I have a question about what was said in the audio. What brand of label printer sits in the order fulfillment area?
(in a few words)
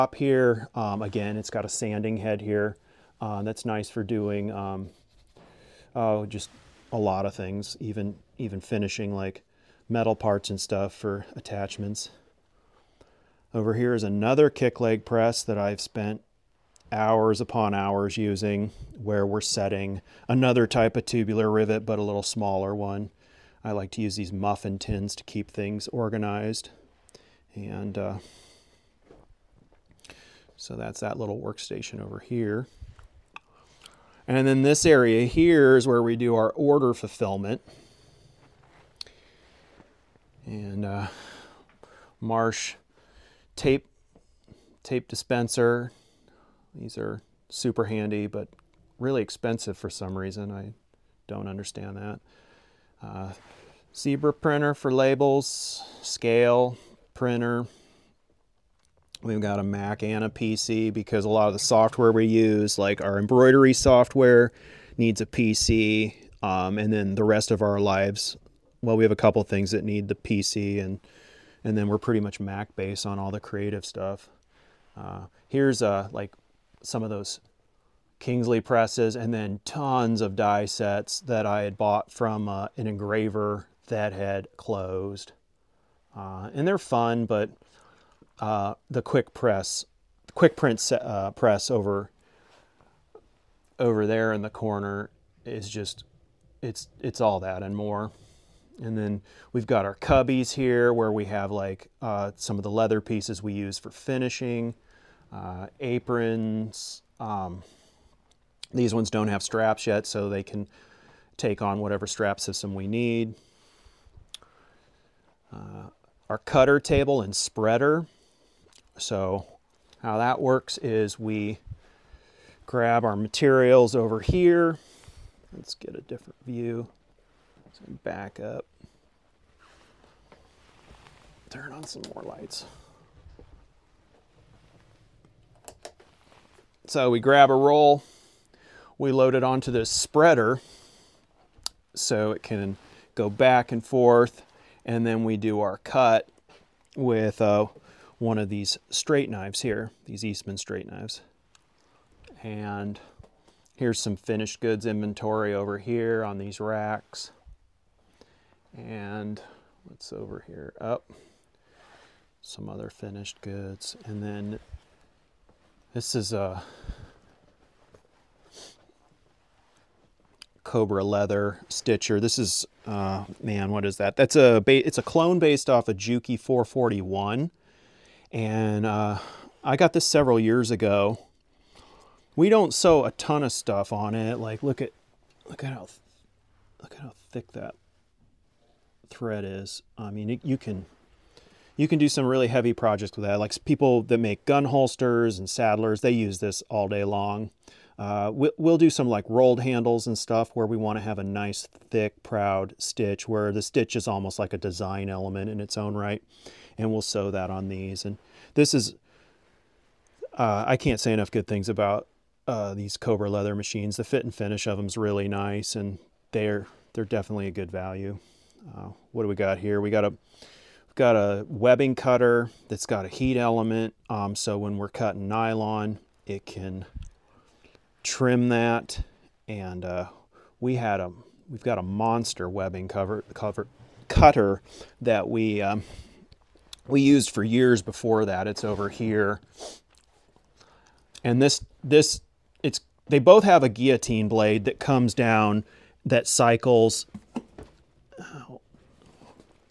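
Zebra.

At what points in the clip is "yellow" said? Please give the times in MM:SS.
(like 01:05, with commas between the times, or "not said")
not said.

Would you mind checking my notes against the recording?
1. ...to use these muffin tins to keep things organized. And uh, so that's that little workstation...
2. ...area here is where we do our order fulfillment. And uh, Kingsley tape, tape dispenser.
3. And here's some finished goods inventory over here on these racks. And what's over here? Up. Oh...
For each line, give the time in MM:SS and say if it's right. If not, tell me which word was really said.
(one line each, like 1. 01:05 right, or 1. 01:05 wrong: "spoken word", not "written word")
1. 00:23 right
2. 00:34 wrong: "Marsh", not "Kingsley"
3. 02:32 right.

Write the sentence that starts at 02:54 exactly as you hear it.
That's a, it's a clone based off a of Juki 441.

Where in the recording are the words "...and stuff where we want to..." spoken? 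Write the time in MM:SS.
03:20.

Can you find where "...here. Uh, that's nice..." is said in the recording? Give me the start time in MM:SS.
00:02.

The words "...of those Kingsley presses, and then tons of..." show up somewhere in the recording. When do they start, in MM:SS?
01:17.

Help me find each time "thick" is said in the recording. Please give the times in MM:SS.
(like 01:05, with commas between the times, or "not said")
03:07, 03:21.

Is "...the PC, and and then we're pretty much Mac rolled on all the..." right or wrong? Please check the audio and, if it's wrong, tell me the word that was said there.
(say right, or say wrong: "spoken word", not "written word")
wrong: "based", not "rolled".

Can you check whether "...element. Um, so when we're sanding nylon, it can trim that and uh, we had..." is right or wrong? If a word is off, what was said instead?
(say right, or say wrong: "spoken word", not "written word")
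wrong: "cutting", not "sanding".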